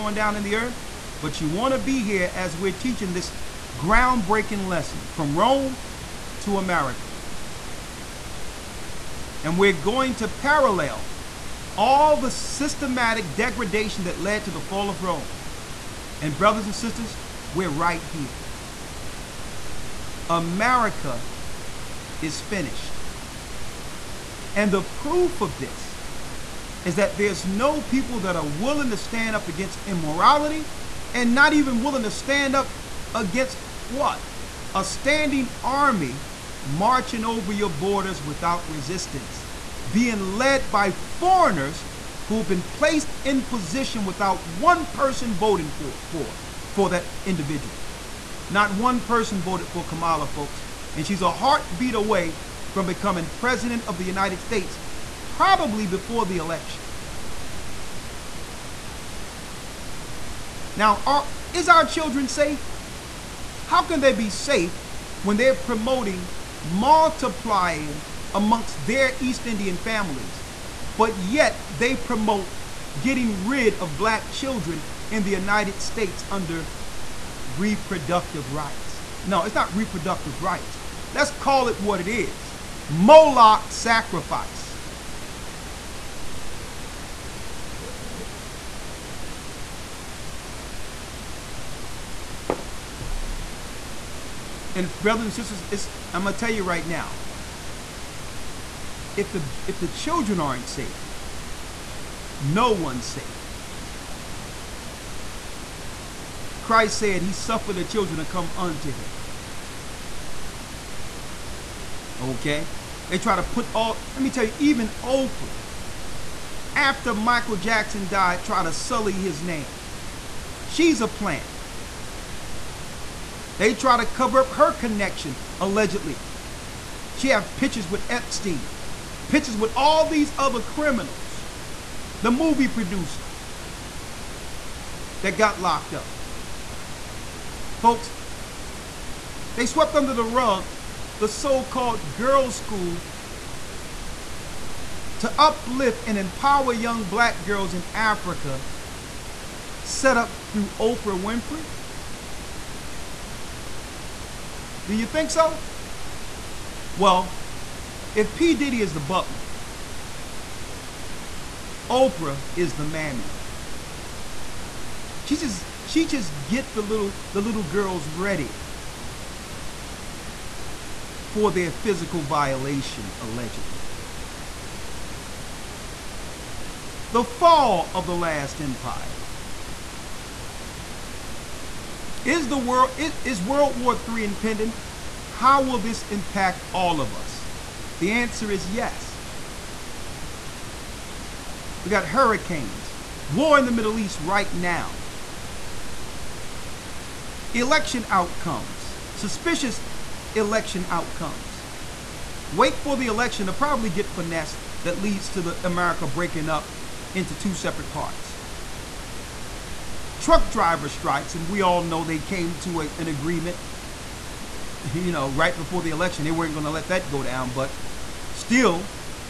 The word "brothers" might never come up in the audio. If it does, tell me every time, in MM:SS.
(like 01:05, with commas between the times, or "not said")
00:16, 01:34.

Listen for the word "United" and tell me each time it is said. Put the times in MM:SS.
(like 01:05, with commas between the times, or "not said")
00:54, 01:15.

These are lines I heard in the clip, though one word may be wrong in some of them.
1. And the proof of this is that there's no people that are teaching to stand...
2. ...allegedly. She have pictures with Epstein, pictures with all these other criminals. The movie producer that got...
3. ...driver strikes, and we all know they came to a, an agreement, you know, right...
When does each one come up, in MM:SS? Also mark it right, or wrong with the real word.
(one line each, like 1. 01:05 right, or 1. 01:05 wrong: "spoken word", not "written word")
1. 00:24 wrong: "willing", not "teaching"
2. 02:05 right
3. 03:30 right.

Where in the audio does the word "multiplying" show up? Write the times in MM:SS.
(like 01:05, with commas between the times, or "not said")
01:06.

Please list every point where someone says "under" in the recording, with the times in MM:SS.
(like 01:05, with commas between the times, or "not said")
01:16, 02:19.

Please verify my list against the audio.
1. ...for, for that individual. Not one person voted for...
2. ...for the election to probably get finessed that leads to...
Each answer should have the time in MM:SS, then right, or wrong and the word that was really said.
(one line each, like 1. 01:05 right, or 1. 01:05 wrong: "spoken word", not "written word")
1. 00:46 right
2. 03:22 right.